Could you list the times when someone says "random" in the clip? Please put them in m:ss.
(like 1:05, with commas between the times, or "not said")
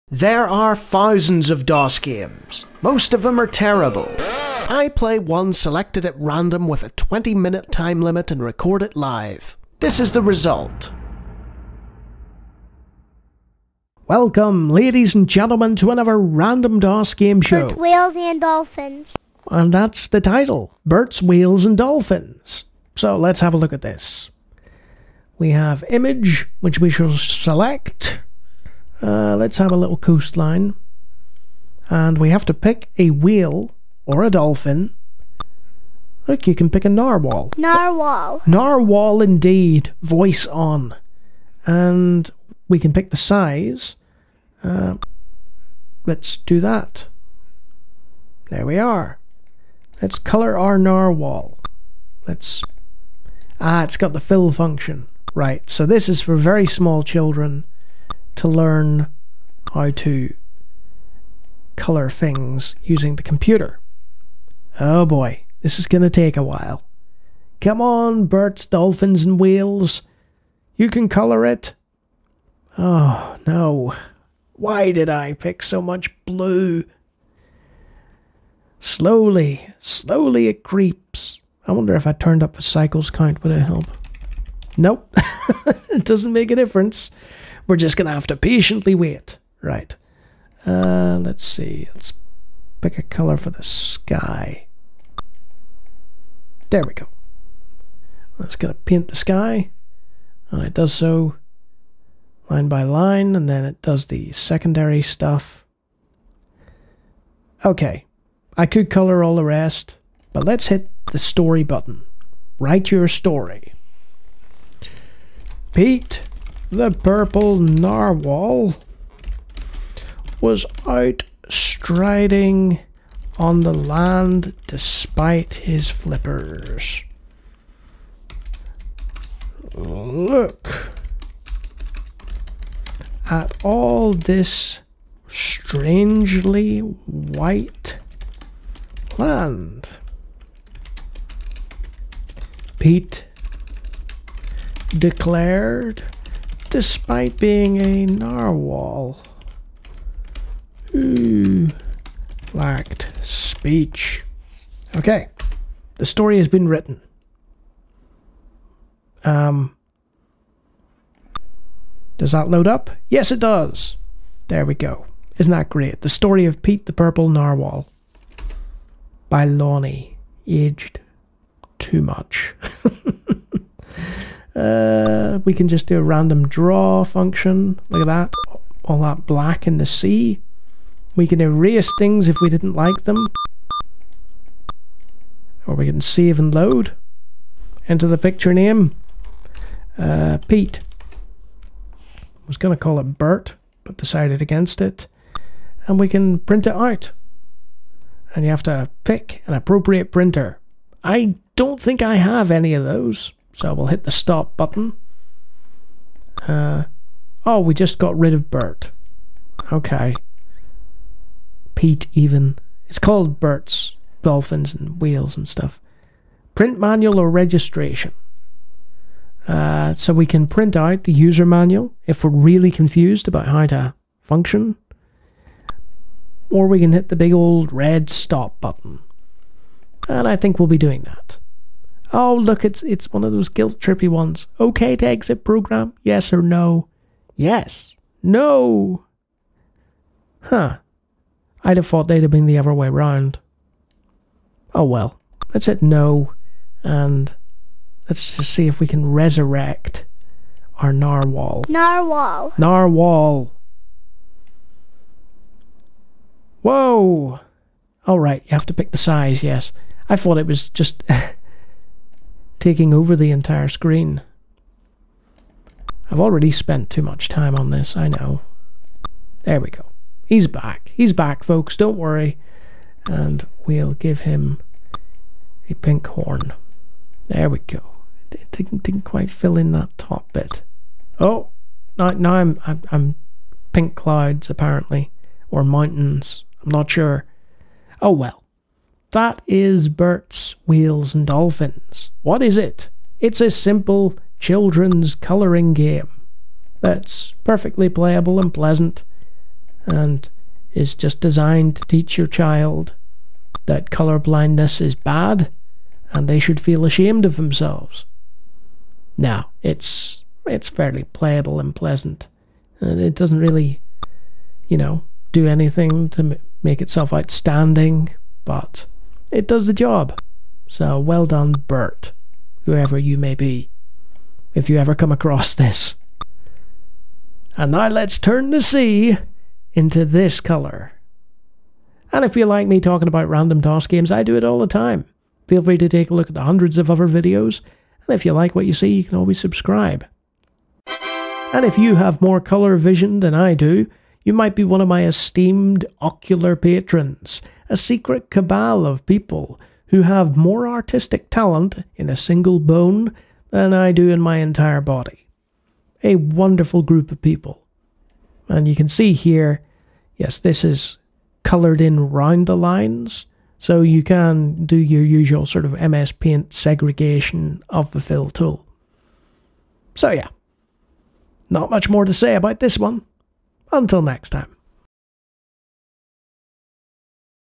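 0:06, 0:16, 2:56, 5:33.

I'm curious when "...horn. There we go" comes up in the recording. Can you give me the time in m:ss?
4:36.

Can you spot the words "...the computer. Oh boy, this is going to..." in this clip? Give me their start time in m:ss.
1:03.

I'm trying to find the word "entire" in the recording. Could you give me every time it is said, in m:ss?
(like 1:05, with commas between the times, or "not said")
4:23, 5:54.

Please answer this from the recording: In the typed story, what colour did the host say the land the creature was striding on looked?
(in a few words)
White.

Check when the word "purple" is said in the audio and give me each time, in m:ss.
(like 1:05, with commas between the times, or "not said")
1:56, 2:46.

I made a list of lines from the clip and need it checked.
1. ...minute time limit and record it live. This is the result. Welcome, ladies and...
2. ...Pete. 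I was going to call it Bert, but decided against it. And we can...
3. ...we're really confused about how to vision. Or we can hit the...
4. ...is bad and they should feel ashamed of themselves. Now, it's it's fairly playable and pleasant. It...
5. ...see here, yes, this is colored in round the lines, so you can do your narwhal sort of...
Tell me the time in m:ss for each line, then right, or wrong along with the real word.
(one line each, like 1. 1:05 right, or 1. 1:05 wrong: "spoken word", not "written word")
1. 0:07 right
2. 3:10 right
3. 3:42 wrong: "function", not "vision"
4. 5:04 right
5. 5:58 wrong: "usual", not "narwhal".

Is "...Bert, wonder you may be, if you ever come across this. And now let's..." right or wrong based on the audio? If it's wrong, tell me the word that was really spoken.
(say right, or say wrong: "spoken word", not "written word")
wrong: "whoever", not "wonder".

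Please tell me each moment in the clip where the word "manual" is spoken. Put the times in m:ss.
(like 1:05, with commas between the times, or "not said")
3:36, 3:41.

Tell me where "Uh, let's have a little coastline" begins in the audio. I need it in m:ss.
0:29.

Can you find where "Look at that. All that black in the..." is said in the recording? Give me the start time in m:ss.
2:57.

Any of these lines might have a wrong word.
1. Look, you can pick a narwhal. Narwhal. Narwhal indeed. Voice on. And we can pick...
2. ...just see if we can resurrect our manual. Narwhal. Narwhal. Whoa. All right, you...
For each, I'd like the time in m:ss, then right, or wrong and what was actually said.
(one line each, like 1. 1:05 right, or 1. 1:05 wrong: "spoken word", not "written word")
1. 0:36 right
2. 4:08 wrong: "narwhal", not "manual".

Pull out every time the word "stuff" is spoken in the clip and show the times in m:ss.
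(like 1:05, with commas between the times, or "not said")
1:45, 3:35.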